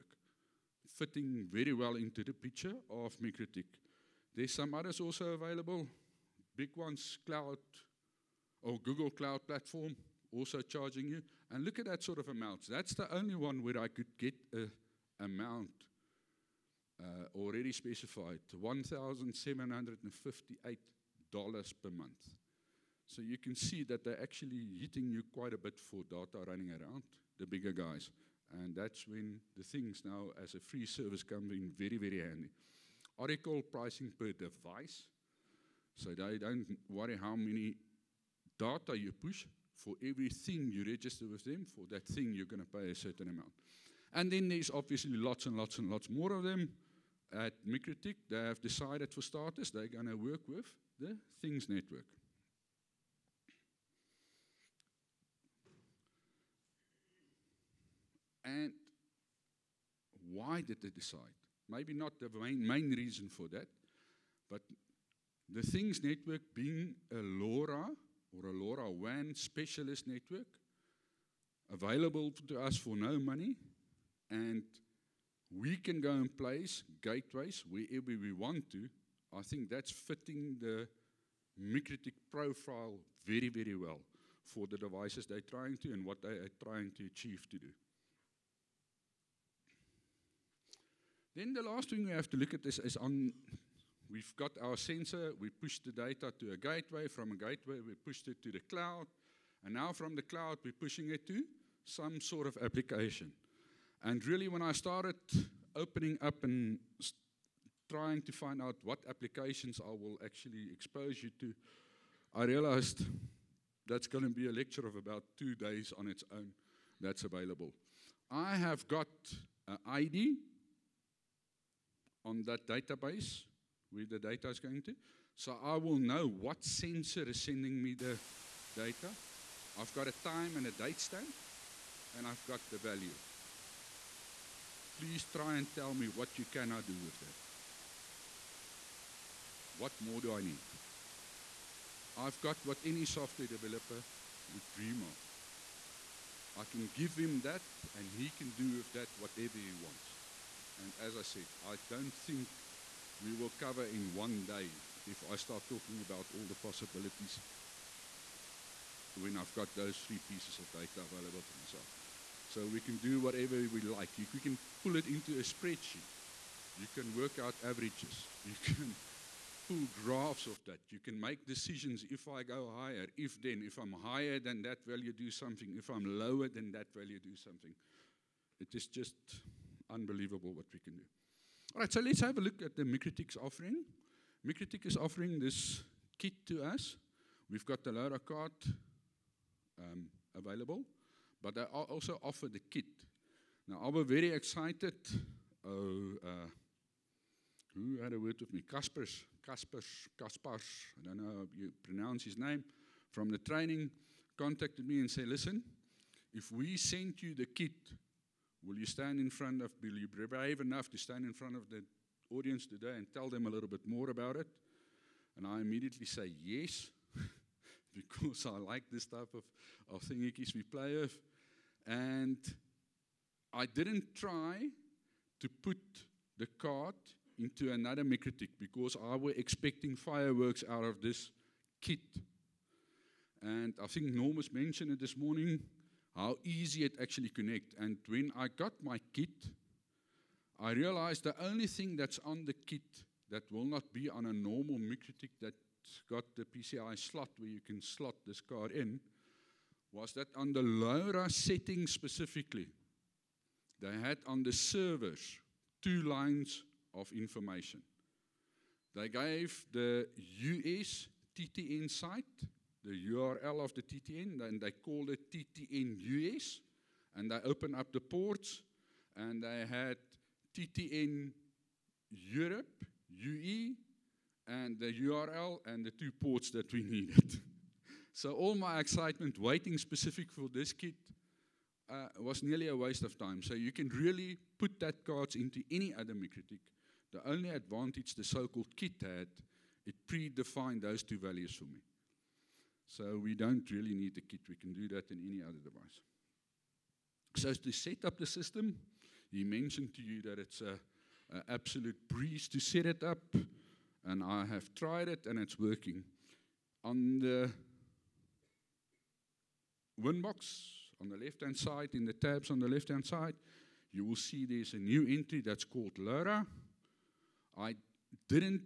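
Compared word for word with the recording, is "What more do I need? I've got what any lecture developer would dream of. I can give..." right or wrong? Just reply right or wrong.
wrong.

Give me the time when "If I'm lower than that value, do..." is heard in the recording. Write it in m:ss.
2:55.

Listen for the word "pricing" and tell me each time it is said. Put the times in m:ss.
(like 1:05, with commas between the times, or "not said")
0:33.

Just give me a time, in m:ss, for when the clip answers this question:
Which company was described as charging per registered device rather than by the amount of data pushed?
0:33.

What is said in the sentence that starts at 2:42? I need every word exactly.
So we can do whatever we like.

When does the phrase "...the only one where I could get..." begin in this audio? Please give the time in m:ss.
0:12.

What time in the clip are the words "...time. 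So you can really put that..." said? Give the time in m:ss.
4:43.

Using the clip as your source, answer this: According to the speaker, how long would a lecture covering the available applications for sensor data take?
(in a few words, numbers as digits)
two days.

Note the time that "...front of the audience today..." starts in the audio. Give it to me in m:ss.
3:31.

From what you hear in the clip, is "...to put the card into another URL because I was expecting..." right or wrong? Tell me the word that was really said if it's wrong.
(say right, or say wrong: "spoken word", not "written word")
wrong: "MikroTik", not "URL".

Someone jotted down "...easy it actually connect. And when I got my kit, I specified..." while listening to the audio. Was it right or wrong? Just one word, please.
wrong.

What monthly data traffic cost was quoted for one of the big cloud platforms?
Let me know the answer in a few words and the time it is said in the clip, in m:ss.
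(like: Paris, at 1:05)
$1,758, at 0:18.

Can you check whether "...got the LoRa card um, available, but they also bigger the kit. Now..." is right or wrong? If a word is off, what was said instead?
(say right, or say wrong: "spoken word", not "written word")
wrong: "offer", not "bigger".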